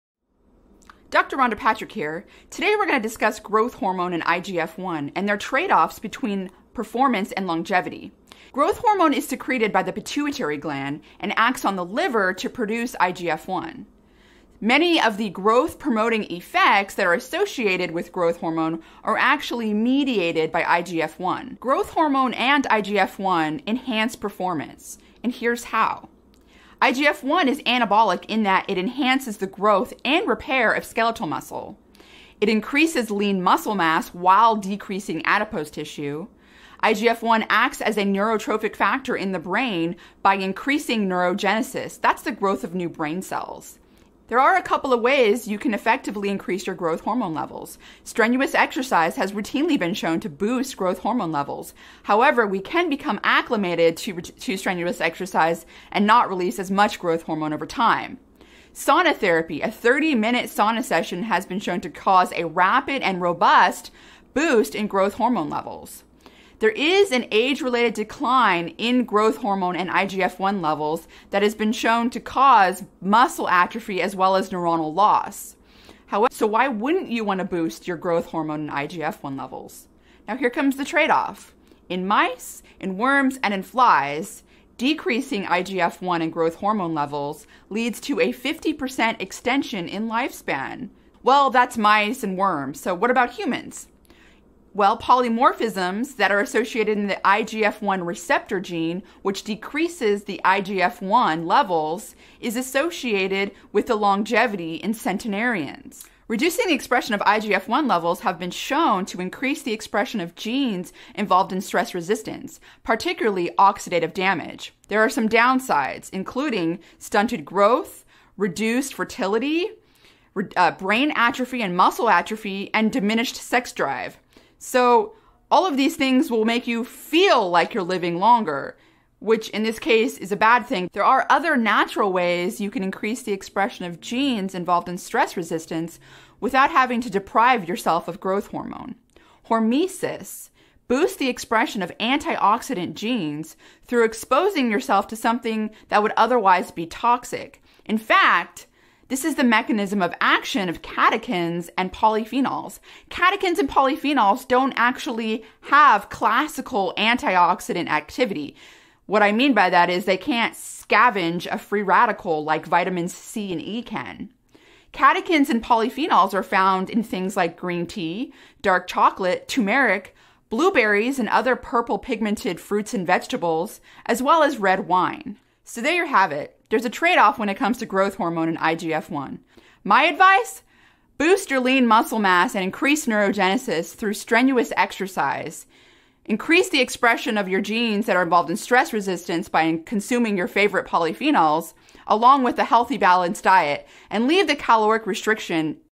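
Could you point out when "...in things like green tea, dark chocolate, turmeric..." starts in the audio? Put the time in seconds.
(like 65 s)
166 s.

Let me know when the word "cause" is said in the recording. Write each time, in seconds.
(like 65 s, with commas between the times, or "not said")
61 s, 72 s.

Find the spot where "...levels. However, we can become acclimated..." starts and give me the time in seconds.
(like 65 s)
51 s.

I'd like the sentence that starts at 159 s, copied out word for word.
What I mean by that is they can't scavenge a free radical like vitamins C and E can.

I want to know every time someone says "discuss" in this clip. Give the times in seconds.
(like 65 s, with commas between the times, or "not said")
3 s.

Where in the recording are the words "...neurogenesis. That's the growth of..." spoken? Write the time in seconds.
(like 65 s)
41 s.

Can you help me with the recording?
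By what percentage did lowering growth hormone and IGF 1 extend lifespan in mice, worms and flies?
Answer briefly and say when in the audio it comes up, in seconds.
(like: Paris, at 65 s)
50%, at 88 s.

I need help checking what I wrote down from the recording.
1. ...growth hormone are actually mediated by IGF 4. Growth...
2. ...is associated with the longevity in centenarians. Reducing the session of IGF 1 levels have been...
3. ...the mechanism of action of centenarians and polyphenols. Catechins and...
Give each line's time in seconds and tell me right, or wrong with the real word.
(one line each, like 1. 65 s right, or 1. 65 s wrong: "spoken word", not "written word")
1. 18 s wrong: "1", not "4"
2. 102 s wrong: "expression", not "session"
3. 149 s wrong: "catechins", not "centenarians".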